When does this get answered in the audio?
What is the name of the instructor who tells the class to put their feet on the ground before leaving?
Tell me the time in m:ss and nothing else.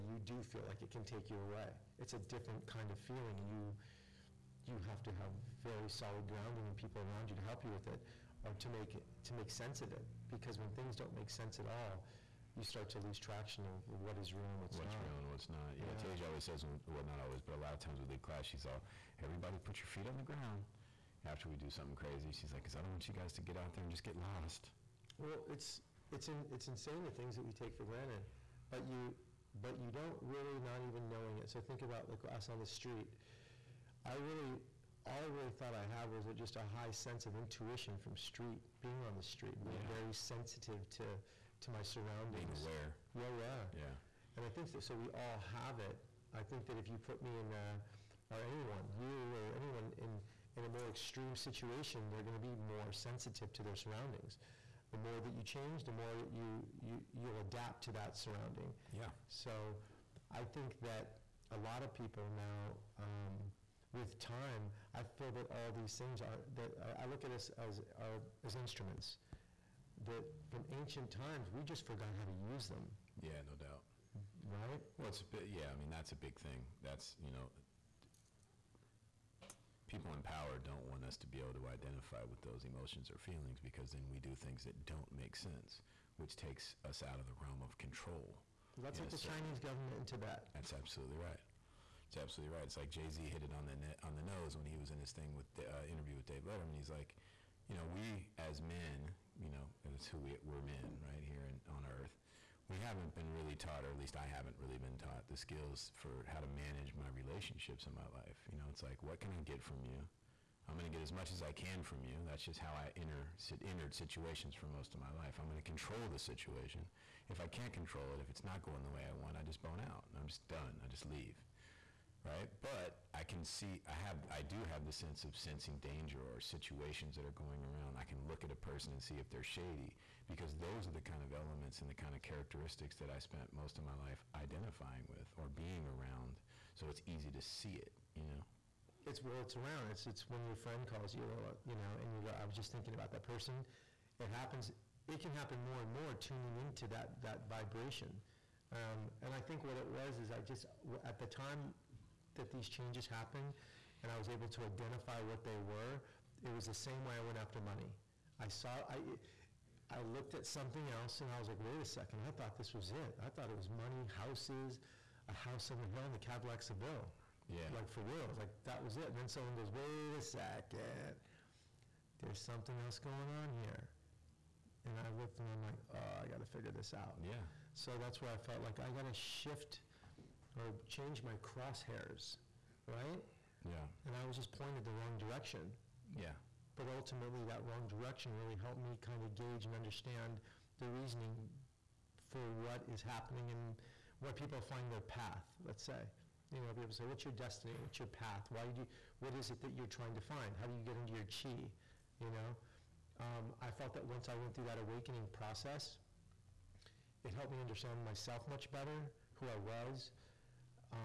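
0:16.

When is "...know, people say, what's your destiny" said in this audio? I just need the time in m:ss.
3:16.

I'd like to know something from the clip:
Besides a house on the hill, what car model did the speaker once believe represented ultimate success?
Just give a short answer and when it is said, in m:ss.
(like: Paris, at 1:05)
Cadillac Seville, at 2:46.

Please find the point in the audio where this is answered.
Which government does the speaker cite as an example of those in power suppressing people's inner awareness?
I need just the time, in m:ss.
1:29.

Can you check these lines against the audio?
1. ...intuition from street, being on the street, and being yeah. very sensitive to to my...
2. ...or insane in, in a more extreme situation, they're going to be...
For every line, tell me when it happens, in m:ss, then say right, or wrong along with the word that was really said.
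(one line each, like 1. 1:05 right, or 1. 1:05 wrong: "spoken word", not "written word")
1. 0:37 right
2. 0:49 wrong: "anyone", not "insane".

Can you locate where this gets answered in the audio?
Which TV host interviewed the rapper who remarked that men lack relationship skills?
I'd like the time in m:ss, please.
1:36.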